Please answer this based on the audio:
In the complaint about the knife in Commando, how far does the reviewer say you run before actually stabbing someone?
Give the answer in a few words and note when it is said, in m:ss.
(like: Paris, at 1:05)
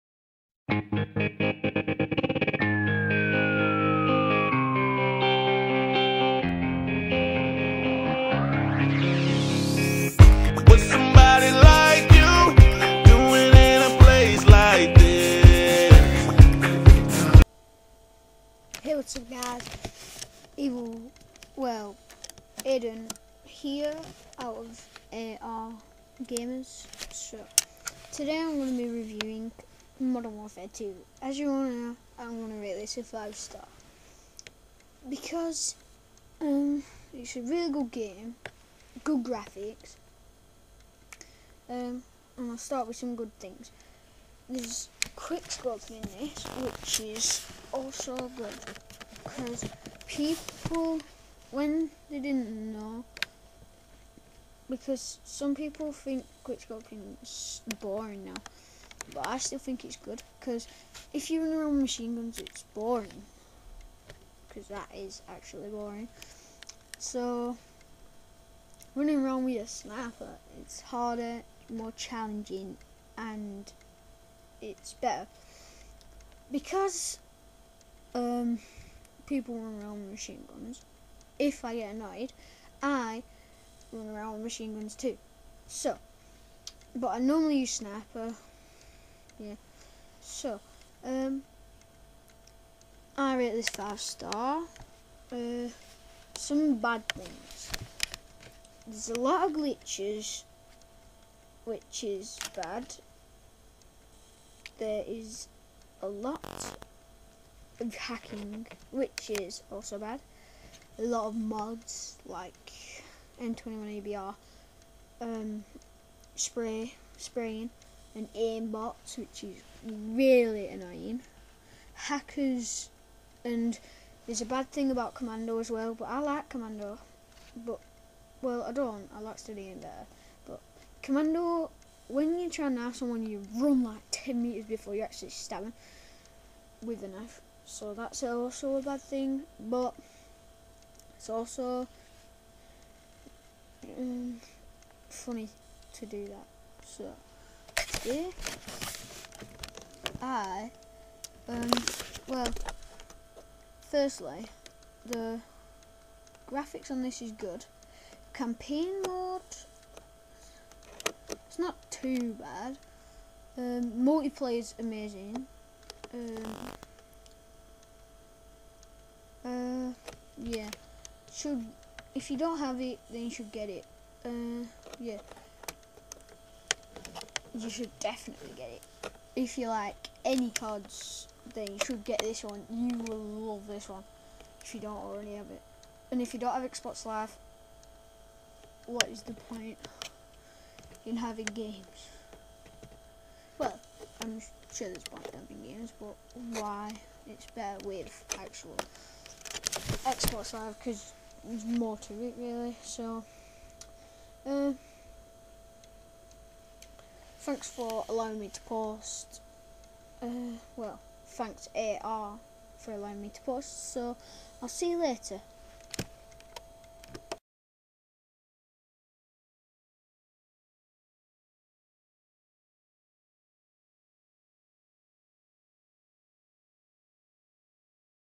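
10 metres, at 2:14.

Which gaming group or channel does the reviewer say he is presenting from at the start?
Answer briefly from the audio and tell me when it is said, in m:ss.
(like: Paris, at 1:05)
AR Gamers, at 0:25.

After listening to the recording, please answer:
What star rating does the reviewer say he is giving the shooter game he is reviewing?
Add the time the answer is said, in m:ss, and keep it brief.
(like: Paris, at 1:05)
5 stars, at 0:33.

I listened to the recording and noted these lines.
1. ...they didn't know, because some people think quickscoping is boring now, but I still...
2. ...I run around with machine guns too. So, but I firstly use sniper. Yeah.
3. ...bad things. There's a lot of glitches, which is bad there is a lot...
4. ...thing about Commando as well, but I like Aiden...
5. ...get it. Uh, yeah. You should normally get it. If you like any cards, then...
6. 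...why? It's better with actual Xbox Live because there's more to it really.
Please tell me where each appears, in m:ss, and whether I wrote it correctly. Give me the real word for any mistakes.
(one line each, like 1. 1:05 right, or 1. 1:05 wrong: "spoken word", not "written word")
1. 0:52 right
2. 1:22 wrong: "normally", not "firstly"
3. 1:36 right
4. 2:04 wrong: "Commando", not "Aiden"
5. 2:53 wrong: "definitely", not "normally"
6. 3:16 right.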